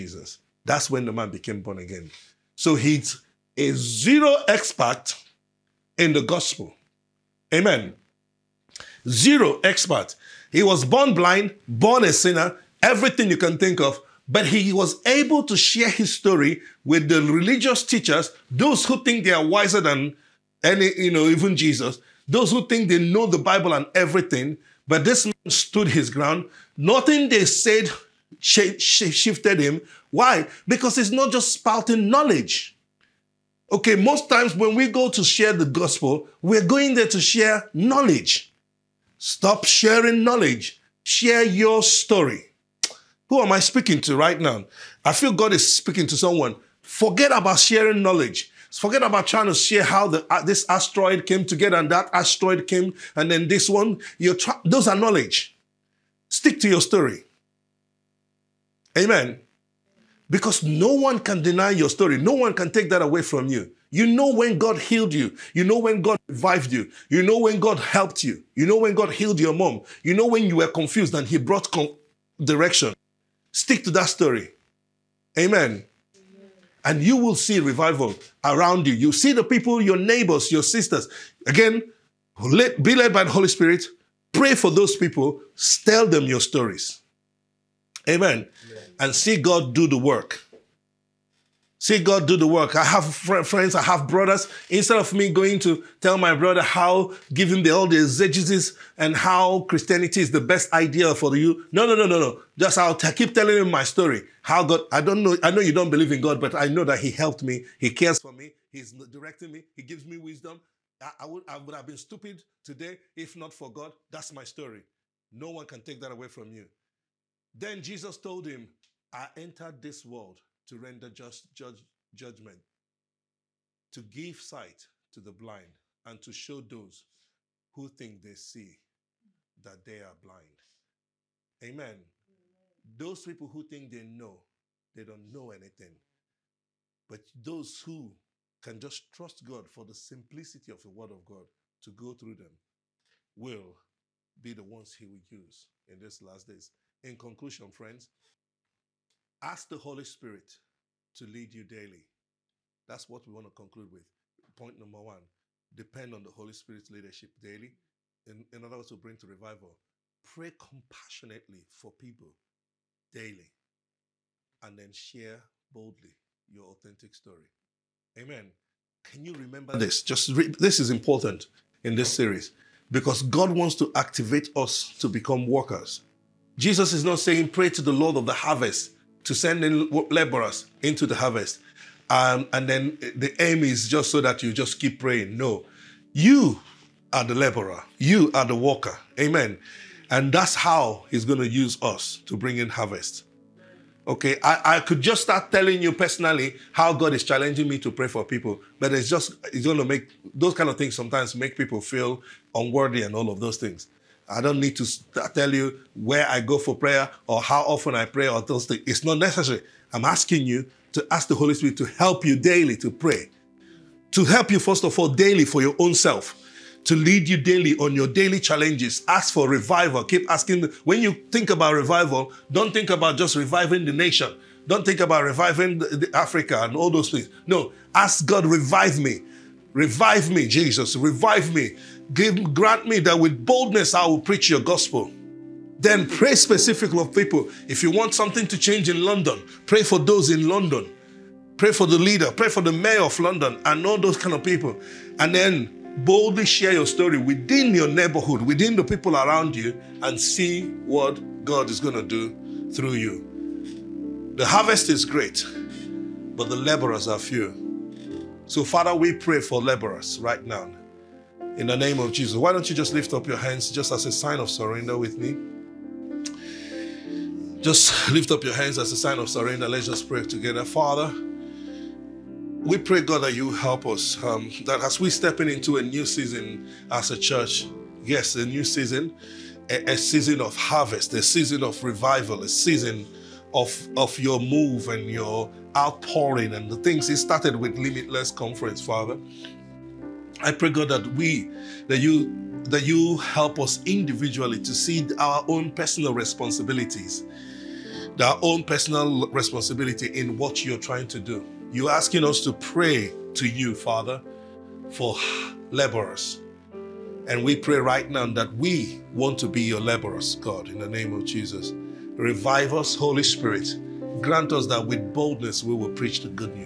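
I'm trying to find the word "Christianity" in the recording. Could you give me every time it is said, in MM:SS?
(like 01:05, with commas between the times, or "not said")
01:39.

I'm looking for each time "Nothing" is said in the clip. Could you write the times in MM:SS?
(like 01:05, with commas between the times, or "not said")
00:26.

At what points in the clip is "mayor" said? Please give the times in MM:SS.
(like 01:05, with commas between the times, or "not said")
04:02.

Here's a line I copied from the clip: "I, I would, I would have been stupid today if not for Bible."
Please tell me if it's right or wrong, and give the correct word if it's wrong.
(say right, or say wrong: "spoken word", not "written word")
wrong: "God", not "Bible".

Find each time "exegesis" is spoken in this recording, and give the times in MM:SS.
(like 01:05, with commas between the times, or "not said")
01:37.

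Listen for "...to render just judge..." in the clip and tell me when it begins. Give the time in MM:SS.
02:00.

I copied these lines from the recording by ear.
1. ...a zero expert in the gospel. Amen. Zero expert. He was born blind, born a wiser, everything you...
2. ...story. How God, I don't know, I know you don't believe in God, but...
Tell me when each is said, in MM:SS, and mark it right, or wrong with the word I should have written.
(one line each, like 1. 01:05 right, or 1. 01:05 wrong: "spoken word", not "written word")
1. 00:03 wrong: "sinner", not "wiser"
2. 01:43 right.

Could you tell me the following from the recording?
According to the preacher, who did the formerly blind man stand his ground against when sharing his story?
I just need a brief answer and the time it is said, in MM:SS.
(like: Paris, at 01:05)
religious teachers, at 00:17.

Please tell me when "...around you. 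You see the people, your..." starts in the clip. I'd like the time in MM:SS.
01:18.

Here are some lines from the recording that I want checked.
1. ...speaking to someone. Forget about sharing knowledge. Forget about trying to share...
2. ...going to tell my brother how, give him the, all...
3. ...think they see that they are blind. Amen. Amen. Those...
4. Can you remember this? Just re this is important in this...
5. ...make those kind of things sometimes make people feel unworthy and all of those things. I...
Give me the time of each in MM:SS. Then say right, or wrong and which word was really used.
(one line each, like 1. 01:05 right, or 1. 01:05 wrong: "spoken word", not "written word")
1. 00:45 right
2. 01:35 right
3. 02:07 right
4. 02:49 right
5. 03:19 right.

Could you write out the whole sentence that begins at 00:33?
Okay, most times when we go to share the gospel, we're going there to share knowledge.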